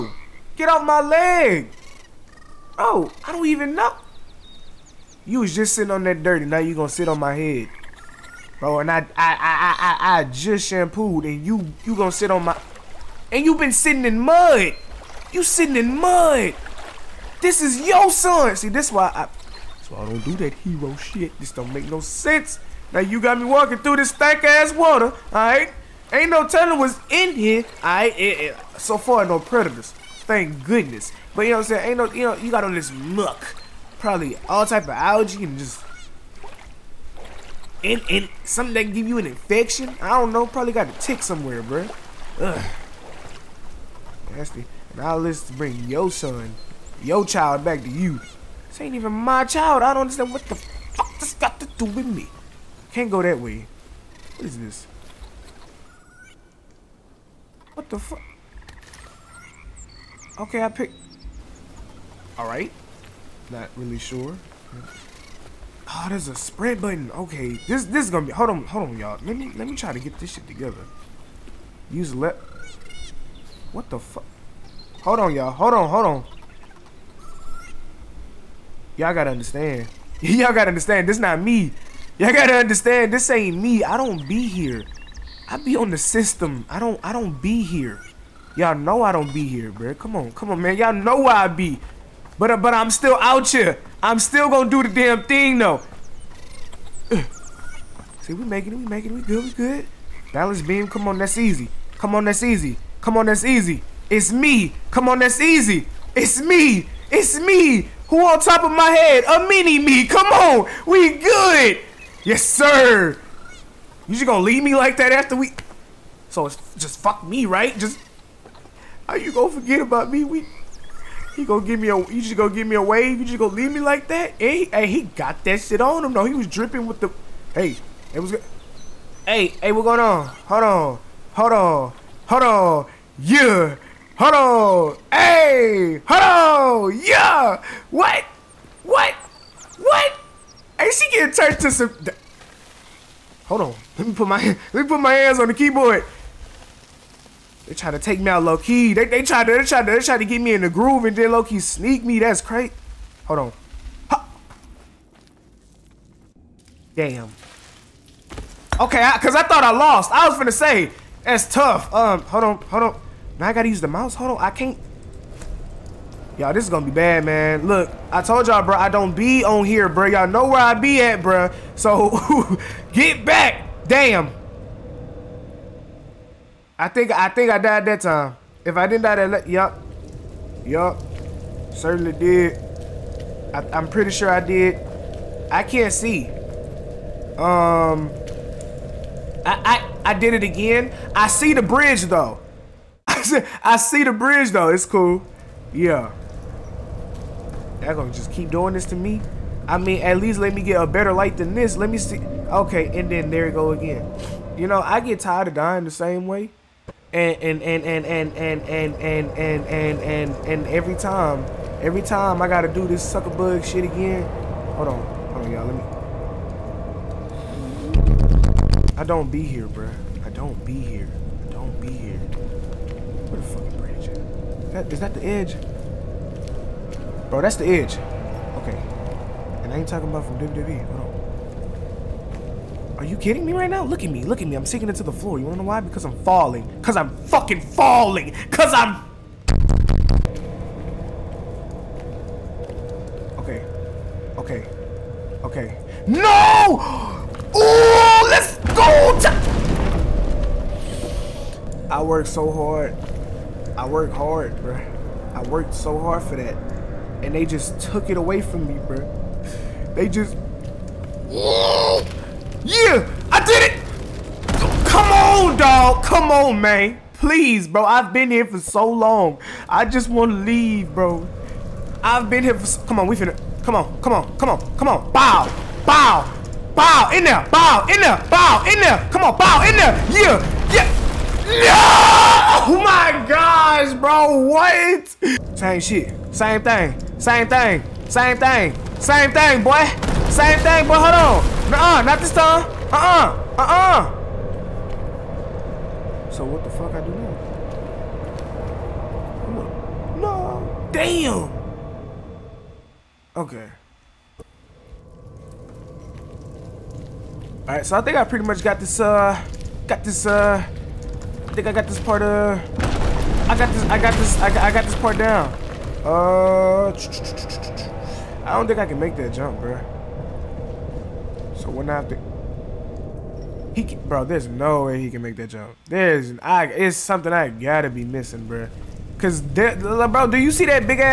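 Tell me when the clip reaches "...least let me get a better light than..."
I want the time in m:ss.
3:20.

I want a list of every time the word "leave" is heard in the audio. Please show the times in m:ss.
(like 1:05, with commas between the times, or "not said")
1:54, 2:03, 4:30.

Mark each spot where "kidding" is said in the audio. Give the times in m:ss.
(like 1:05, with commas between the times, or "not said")
3:53.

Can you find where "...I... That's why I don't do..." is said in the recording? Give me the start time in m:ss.
0:19.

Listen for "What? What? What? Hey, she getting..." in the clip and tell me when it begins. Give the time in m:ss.
2:17.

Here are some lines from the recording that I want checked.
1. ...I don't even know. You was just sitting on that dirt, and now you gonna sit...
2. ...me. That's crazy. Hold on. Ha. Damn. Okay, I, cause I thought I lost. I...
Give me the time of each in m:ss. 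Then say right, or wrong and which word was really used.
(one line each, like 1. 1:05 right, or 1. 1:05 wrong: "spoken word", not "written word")
1. 0:03 right
2. 2:32 right.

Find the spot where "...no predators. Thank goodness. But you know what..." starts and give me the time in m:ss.
0:29.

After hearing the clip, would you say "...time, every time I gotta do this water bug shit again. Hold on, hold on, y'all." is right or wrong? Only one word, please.
wrong.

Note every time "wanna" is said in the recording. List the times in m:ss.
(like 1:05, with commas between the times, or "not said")
3:55.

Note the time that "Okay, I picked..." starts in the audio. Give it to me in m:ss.
1:00.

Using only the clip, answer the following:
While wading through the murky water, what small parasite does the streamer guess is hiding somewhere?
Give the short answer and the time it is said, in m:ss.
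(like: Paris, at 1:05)
tick, at 0:40.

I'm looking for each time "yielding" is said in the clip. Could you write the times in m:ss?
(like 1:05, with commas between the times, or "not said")
not said.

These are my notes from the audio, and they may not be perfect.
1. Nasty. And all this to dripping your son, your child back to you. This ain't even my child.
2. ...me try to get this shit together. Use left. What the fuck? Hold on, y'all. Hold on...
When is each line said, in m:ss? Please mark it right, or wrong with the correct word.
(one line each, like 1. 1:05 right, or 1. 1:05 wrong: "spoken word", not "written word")
1. 0:44 wrong: "bring", not "dripping"
2. 1:09 right.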